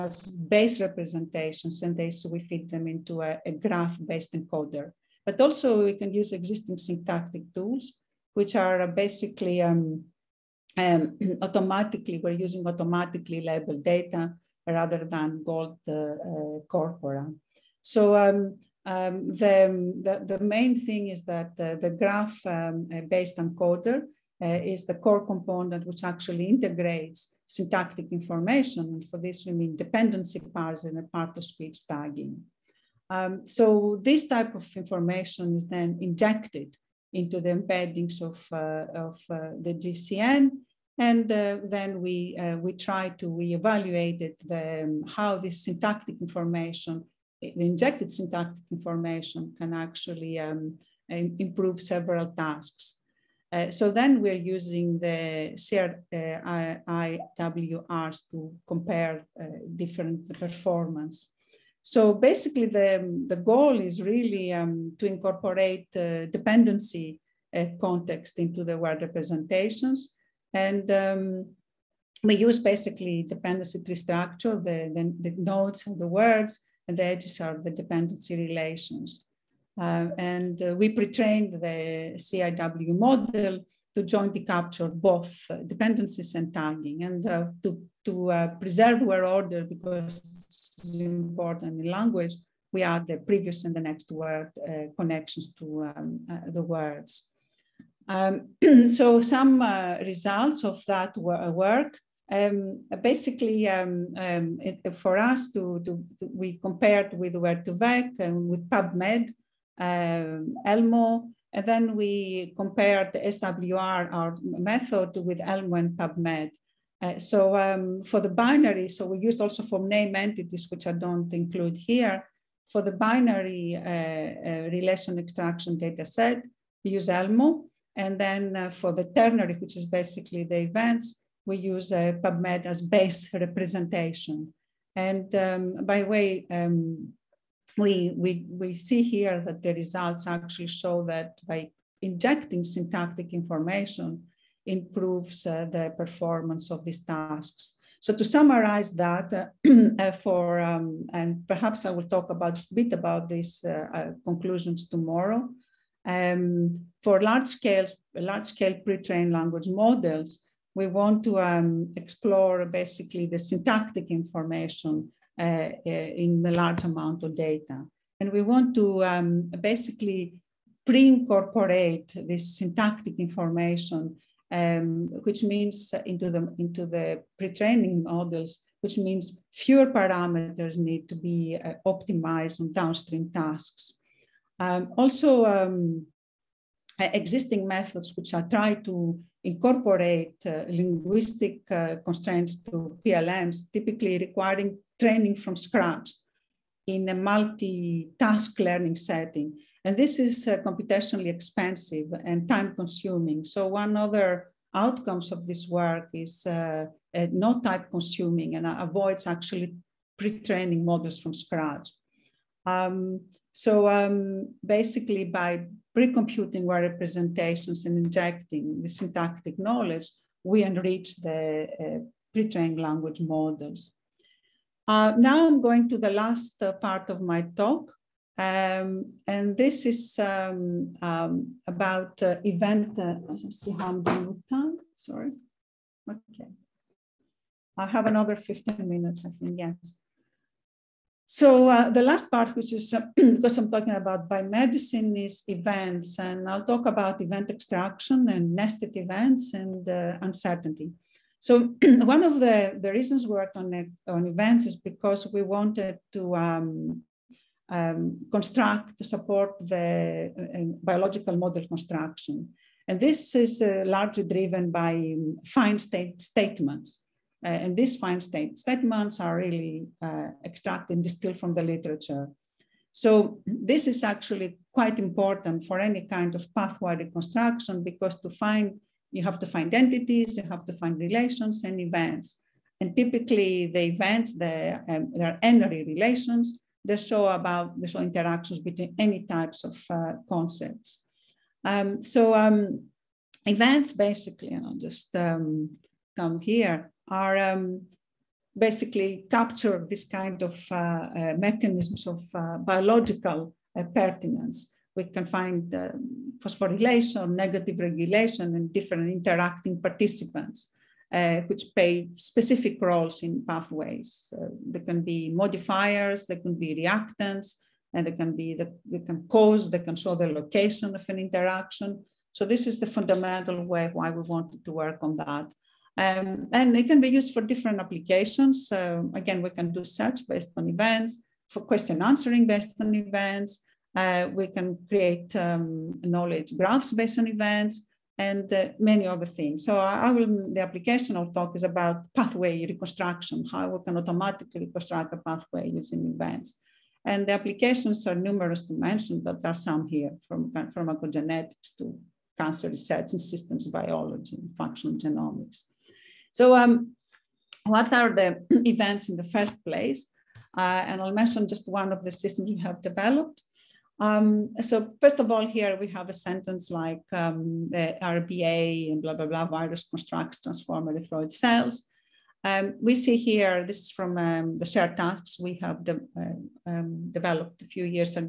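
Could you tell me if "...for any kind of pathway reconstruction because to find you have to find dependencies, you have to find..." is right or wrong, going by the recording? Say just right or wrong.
wrong.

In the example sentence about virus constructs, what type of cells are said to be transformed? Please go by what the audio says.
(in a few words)
erythroid cells.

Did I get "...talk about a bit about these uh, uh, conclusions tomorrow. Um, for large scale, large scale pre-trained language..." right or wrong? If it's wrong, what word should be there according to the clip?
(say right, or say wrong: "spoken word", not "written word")
right.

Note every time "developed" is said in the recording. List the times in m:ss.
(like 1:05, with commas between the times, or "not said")
6:02, 6:17.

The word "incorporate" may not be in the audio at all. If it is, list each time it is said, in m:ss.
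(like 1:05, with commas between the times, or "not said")
1:05, 2:50, 3:09.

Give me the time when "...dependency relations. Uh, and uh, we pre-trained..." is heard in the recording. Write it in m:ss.
1:17.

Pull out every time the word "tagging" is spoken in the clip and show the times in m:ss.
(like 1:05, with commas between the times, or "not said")
0:31, 1:26.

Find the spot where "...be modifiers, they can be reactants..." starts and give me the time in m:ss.
5:15.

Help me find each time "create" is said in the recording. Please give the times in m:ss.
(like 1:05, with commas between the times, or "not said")
5:34.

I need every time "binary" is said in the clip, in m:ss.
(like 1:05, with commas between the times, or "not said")
1:58, 2:02.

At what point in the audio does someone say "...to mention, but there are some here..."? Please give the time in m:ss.
5:48.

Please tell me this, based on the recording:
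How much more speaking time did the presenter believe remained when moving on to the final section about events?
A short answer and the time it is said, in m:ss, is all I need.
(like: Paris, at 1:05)
15 minutes, at 3:58.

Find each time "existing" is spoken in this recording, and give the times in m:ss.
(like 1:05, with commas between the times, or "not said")
0:06, 3:07.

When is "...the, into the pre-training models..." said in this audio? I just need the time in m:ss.
2:56.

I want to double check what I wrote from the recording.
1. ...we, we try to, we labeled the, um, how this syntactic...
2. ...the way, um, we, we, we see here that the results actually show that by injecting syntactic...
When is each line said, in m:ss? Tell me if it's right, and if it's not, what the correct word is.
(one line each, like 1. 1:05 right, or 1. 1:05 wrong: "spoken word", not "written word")
1. 0:42 wrong: "evaluated", not "labeled"
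2. 2:16 right.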